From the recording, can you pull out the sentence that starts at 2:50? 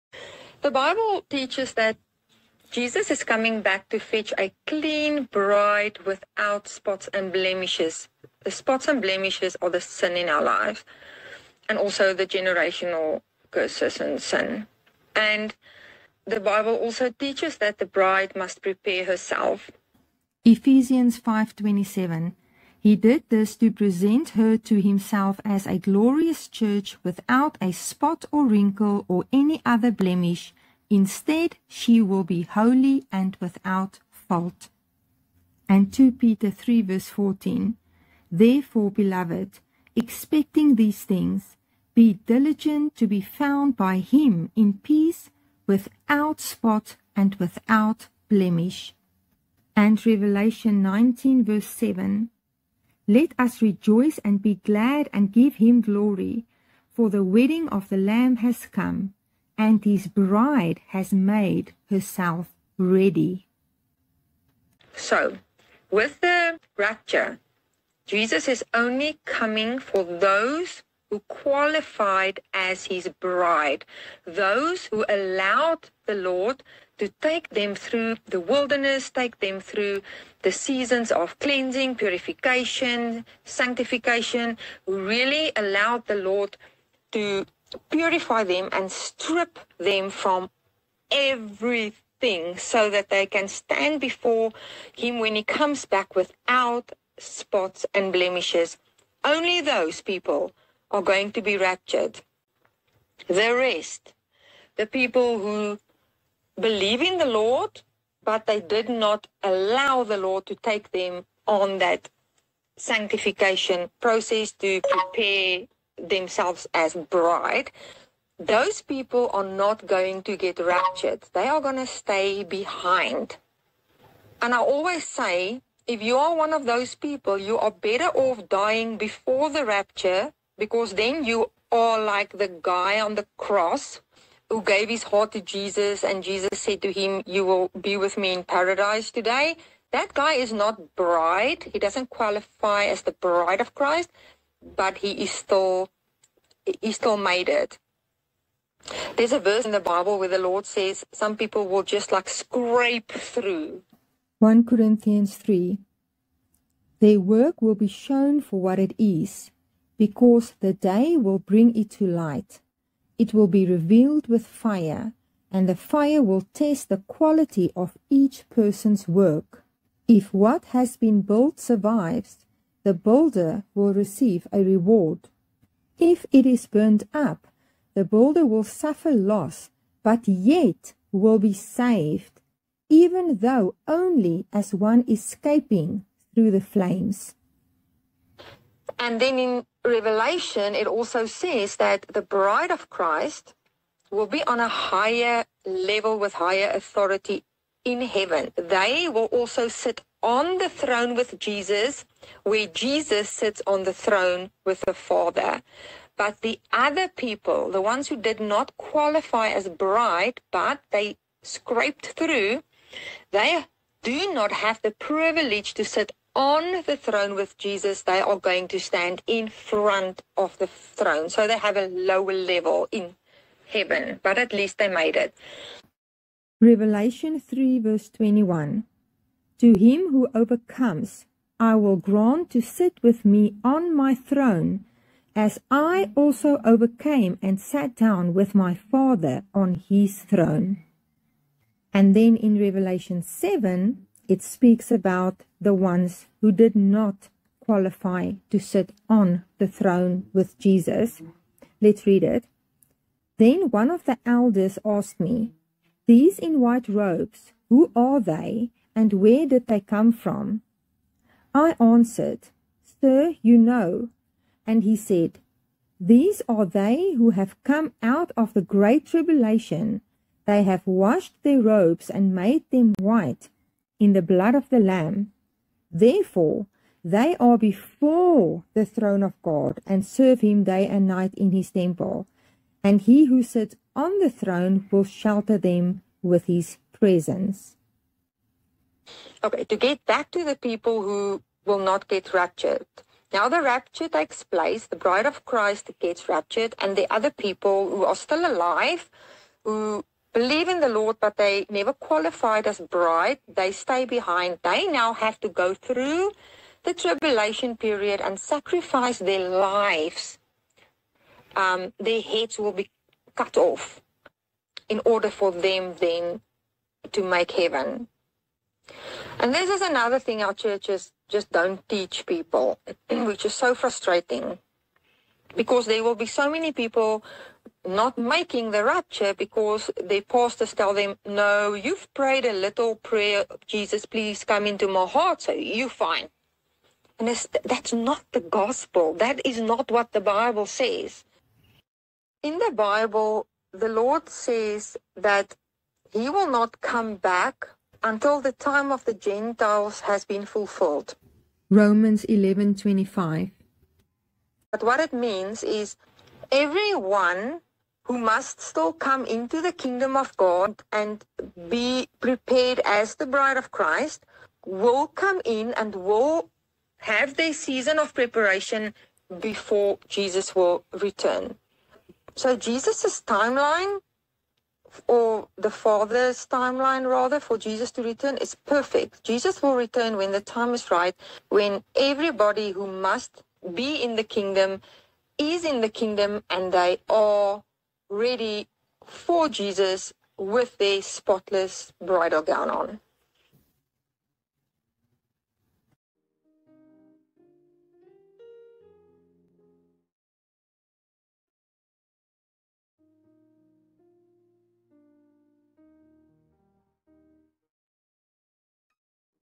If what has been built survives, the builder will receive a reward.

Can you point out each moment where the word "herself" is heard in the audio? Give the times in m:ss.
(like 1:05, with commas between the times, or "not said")
0:19, 1:01.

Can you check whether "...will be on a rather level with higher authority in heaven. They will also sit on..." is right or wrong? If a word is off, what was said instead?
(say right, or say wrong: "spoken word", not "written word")
wrong: "higher", not "rather".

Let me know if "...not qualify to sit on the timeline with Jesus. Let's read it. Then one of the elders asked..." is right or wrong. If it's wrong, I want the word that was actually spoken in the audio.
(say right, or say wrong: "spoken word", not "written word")
wrong: "throne", not "timeline".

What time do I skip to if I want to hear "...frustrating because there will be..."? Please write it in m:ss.
5:23.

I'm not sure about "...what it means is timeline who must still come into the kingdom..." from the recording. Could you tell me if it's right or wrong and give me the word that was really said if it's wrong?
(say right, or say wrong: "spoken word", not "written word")
wrong: "everyone", not "timeline".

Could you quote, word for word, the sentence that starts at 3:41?
So they have a lower level in heaven, but at least they made it.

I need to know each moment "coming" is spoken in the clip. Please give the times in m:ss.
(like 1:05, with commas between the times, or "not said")
0:03, 1:09.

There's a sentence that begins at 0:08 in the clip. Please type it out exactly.
The spots and blemishes are the sin in our lives and also the generational curses and sin.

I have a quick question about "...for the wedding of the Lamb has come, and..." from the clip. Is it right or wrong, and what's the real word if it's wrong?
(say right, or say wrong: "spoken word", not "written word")
right.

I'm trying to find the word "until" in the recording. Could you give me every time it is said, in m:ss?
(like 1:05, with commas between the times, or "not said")
5:48.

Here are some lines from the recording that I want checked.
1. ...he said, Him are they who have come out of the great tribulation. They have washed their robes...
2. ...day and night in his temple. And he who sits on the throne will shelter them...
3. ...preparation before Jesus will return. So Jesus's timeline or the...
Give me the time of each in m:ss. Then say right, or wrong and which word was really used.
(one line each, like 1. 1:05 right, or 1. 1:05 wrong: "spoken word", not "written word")
1. 4:24 wrong: "These", not "Him"
2. 4:40 right
3. 6:08 right.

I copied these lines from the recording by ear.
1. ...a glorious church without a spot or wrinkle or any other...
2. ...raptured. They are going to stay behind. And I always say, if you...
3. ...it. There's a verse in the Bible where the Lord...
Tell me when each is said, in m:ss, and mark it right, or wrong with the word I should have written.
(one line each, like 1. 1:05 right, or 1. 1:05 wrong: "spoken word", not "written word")
1. 0:25 right
2. 2:00 right
3. 2:27 right.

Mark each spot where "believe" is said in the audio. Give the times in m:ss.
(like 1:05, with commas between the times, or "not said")
1:46, 5:00.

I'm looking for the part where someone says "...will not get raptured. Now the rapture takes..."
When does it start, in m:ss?
4:51.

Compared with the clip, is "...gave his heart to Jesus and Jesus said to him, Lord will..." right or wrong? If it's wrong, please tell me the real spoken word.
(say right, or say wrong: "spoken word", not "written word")
wrong: "You", not "Lord".